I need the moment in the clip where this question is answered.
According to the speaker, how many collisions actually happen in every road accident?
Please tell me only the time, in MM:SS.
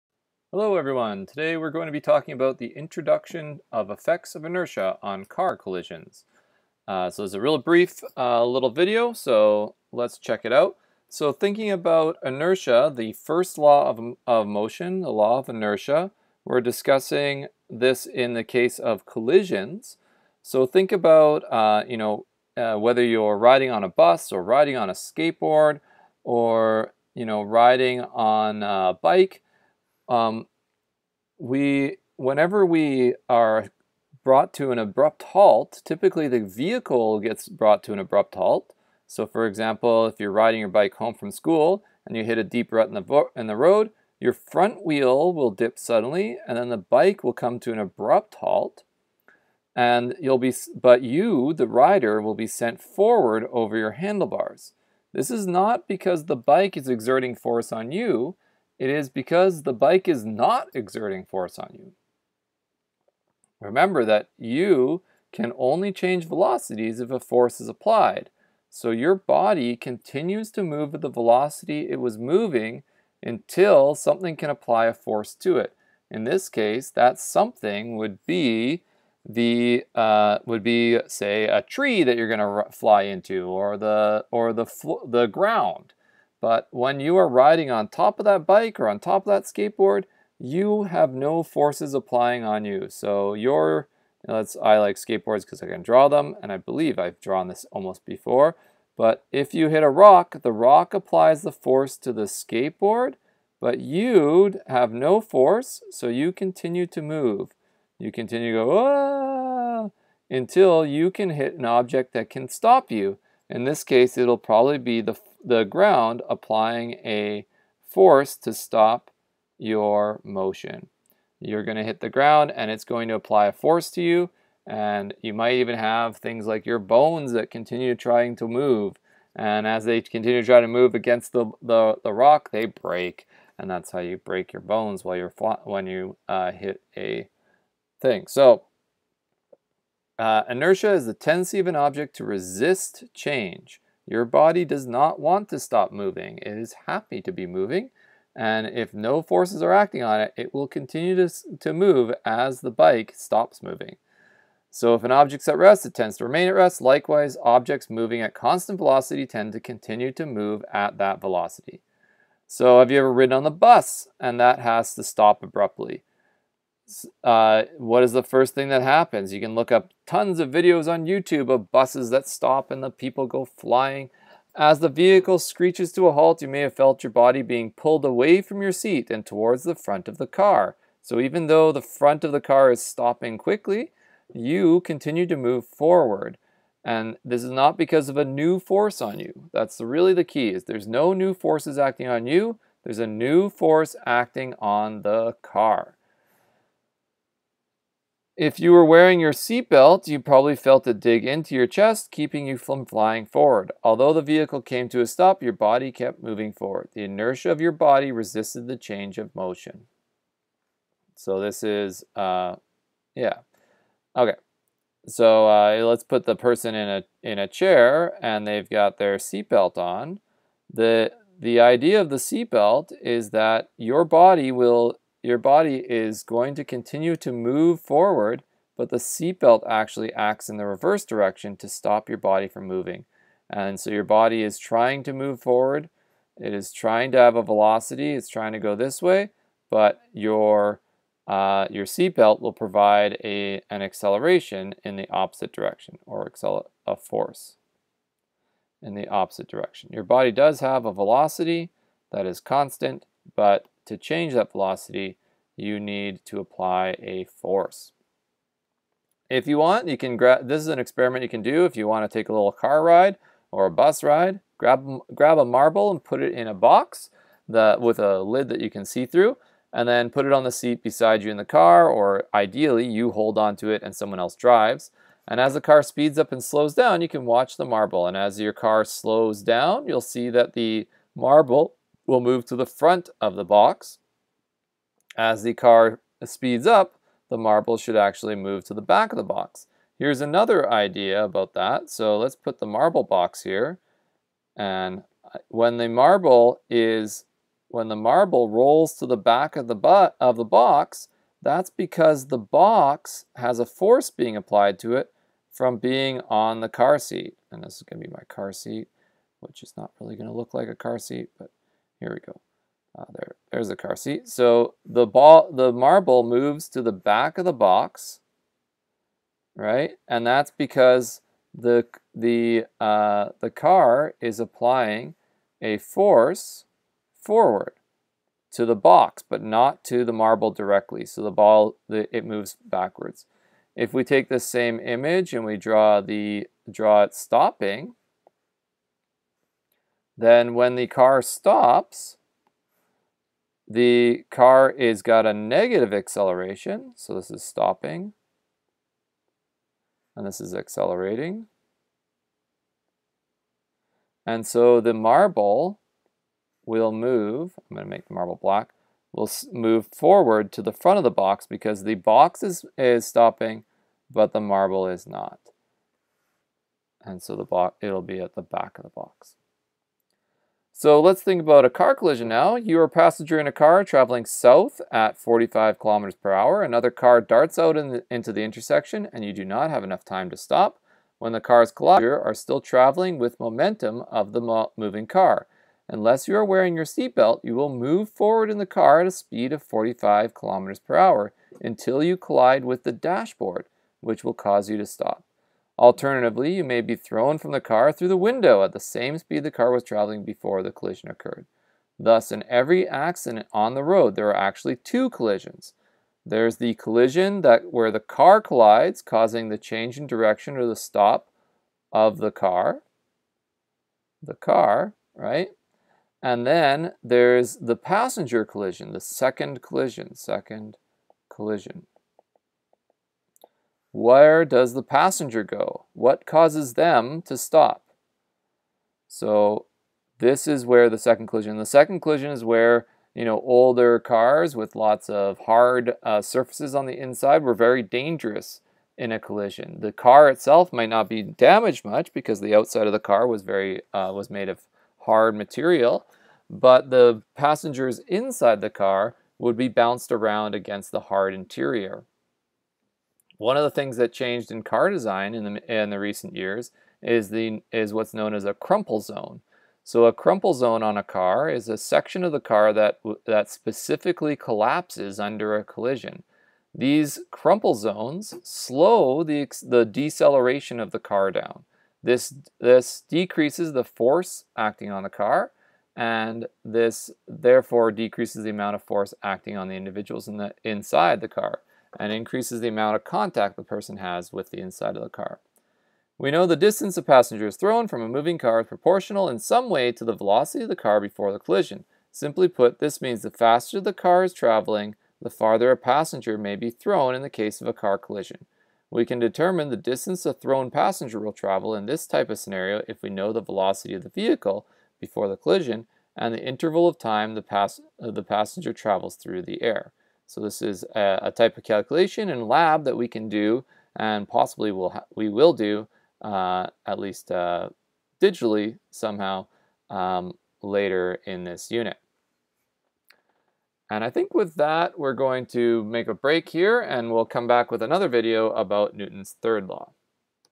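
06:44.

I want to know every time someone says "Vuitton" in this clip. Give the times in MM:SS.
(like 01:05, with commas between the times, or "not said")
not said.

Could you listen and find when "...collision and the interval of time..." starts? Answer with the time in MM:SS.
08:25.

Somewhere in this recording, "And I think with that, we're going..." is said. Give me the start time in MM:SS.
08:43.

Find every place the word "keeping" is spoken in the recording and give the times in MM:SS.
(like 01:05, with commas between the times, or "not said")
03:22.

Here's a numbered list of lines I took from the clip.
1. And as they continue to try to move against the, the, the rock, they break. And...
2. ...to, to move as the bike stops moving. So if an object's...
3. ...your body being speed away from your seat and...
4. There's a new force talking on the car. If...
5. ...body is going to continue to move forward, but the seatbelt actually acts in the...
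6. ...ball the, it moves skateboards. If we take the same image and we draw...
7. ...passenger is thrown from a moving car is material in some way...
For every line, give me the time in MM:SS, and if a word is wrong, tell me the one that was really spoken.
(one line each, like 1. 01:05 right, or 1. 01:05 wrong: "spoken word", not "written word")
1. 02:09 right
2. 02:31 right
3. 02:57 wrong: "pulled", not "speed"
4. 03:12 wrong: "acting", not "talking"
5. 03:45 right
6. 05:31 wrong: "backwards", not "skateboards"
7. 08:07 wrong: "proportional", not "material".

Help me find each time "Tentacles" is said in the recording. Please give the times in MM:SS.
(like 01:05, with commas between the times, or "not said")
not said.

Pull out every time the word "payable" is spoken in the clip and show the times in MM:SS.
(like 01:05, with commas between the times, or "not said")
not said.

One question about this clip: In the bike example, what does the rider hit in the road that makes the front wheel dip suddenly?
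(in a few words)
a deep rut.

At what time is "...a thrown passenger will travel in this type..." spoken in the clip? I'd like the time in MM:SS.
08:20.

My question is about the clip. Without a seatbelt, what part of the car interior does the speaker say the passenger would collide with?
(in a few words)
the dashboard.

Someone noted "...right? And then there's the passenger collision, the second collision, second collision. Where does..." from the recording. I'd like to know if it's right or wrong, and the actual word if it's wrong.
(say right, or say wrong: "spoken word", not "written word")
right.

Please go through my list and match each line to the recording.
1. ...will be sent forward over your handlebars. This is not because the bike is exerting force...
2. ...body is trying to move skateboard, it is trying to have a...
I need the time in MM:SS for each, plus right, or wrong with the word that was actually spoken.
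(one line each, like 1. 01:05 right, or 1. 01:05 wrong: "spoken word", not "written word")
1. 00:52 right
2. 03:54 wrong: "forward", not "skateboard".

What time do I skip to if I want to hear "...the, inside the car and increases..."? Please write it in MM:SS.
08:00.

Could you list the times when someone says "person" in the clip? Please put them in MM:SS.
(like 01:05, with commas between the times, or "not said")
03:36, 08:03.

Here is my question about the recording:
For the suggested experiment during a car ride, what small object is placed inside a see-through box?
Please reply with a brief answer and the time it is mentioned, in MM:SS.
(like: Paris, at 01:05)
a marble, at 04:25.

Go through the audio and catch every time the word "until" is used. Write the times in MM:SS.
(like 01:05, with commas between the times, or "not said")
01:13, 01:50, 06:31.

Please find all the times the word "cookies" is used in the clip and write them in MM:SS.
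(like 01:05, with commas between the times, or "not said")
not said.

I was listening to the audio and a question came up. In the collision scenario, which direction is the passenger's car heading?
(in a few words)
south.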